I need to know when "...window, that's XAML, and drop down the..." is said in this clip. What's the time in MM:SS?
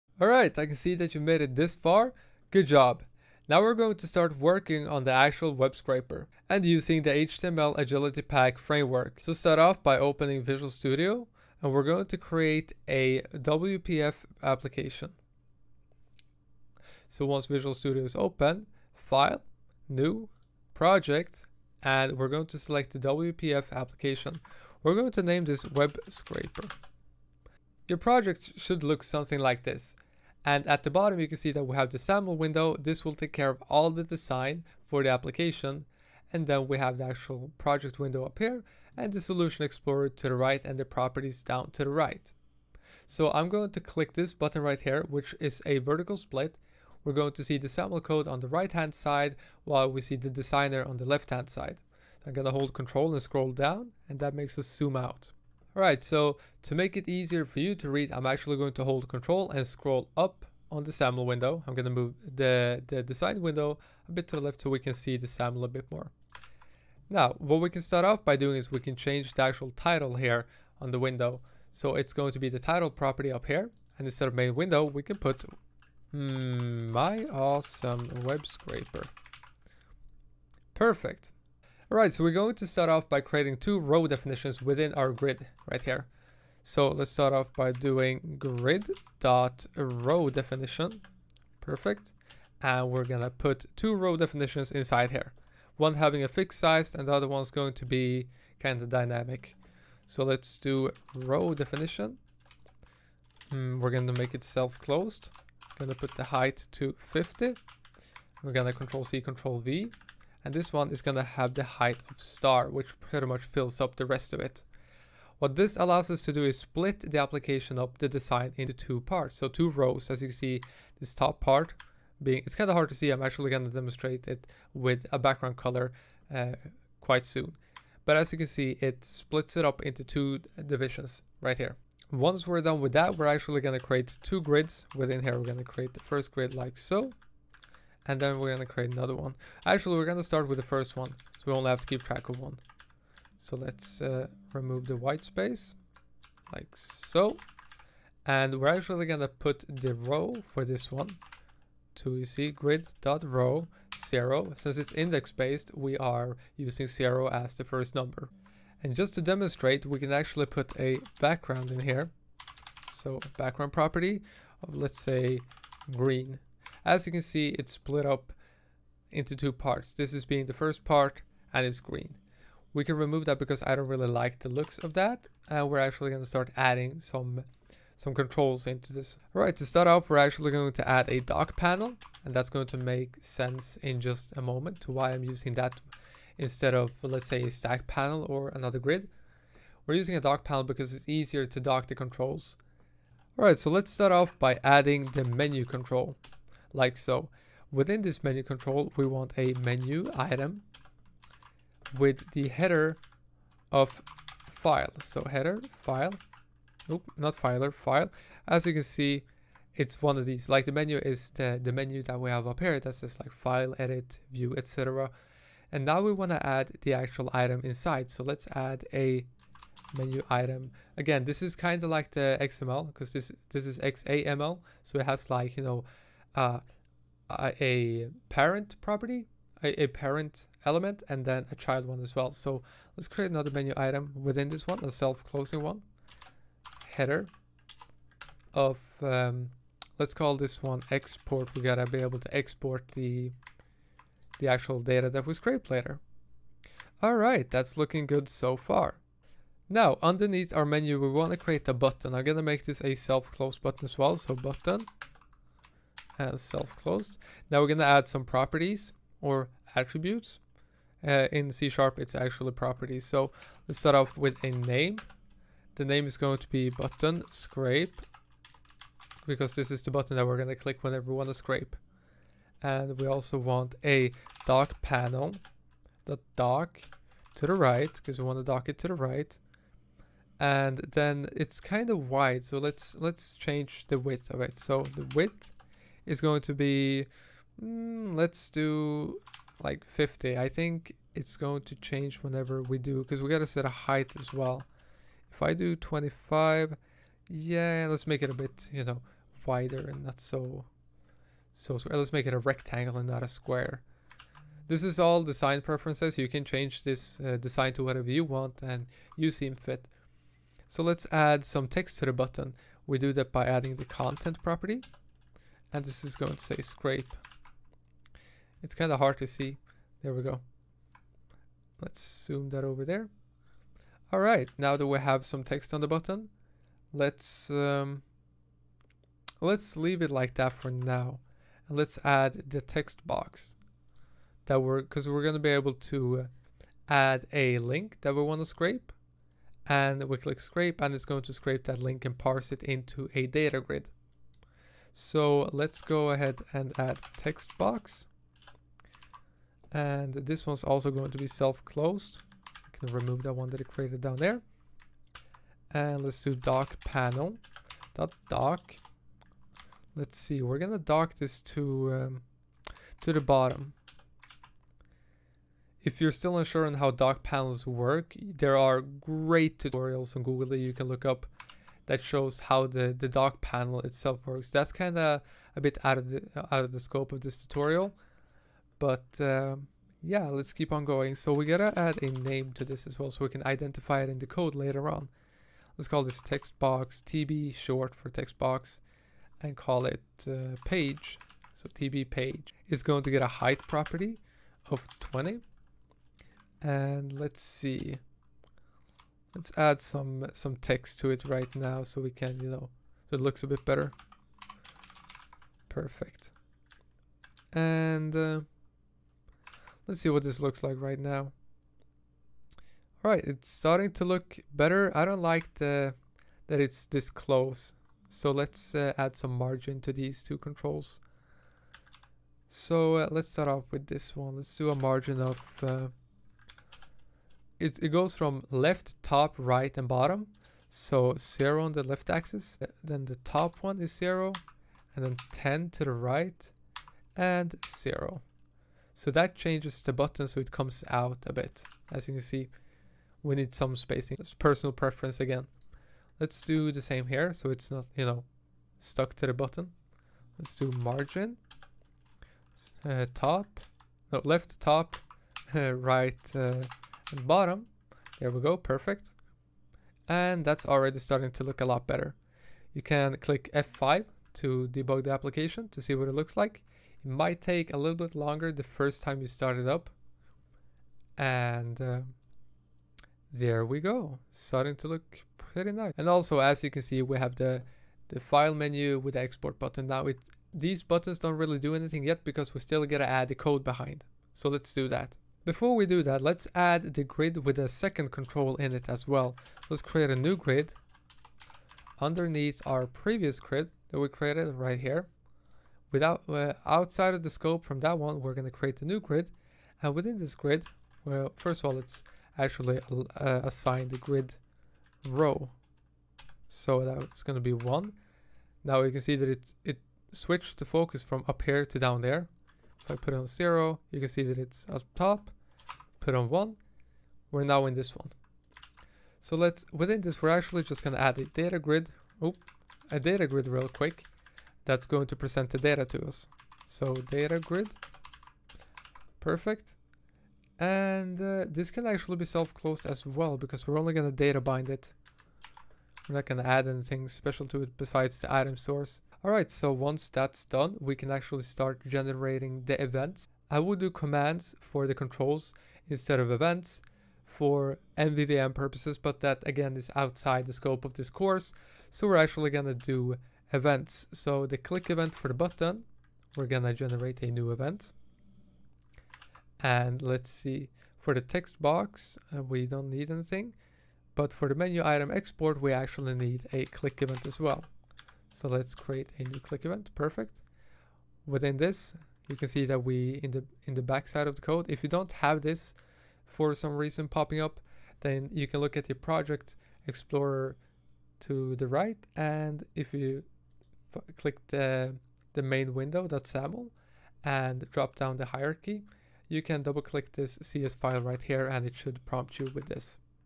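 09:45.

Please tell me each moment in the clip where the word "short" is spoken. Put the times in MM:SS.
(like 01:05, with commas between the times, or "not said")
06:27.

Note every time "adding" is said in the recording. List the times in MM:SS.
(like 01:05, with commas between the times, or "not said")
02:56, 03:14, 05:13.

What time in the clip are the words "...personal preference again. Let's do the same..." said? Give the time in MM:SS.
07:24.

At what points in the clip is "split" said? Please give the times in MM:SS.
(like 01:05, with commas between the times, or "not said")
00:46, 01:56, 02:09, 02:47.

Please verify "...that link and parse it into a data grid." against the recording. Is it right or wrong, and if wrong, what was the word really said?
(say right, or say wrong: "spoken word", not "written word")
right.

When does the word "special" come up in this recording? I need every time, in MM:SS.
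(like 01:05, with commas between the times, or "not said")
08:57.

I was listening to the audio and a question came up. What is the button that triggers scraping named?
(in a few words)
button scrape.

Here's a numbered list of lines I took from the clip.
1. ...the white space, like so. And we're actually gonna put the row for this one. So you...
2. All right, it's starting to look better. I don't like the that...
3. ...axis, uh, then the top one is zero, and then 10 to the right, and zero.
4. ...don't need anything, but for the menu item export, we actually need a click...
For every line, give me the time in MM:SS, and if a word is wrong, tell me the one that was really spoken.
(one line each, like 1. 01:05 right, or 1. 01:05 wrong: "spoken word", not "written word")
1. 02:24 right
2. 06:53 right
3. 07:12 right
4. 09:22 right.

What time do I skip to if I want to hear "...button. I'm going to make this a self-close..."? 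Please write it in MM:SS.
04:11.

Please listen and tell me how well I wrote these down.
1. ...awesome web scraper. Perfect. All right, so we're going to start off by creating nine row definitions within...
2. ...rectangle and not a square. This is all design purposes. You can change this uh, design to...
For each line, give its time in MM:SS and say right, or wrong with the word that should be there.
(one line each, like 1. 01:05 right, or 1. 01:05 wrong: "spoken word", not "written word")
1. 01:17 wrong: "two", not "nine"
2. 05:02 wrong: "preferences", not "purposes".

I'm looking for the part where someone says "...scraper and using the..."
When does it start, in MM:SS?
00:05.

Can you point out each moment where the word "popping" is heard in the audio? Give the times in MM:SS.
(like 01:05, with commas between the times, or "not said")
09:37.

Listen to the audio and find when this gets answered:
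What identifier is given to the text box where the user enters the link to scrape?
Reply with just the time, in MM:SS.
06:31.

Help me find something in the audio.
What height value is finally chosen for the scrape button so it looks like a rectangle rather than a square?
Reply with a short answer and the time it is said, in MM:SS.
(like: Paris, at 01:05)
25, at 04:55.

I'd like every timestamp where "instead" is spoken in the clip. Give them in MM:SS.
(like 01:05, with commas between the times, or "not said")
01:14, 03:06, 09:05.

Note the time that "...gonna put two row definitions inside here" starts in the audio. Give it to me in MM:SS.
01:33.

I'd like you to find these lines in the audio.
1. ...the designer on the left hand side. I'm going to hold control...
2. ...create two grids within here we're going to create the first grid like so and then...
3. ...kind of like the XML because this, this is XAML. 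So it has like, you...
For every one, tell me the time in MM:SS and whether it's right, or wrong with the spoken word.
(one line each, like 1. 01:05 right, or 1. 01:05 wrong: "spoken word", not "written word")
1. 00:50 right
2. 02:13 right
3. 03:41 right.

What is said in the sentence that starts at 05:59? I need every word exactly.
Let's see, we're gonna dock this to um, to the bottom.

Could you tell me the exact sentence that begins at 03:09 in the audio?
We're using a dock panel because it's easier to dock the controls.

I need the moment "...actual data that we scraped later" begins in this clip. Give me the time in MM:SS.
04:04.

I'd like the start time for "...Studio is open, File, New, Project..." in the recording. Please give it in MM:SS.
00:17.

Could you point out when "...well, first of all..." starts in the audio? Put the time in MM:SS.
08:21.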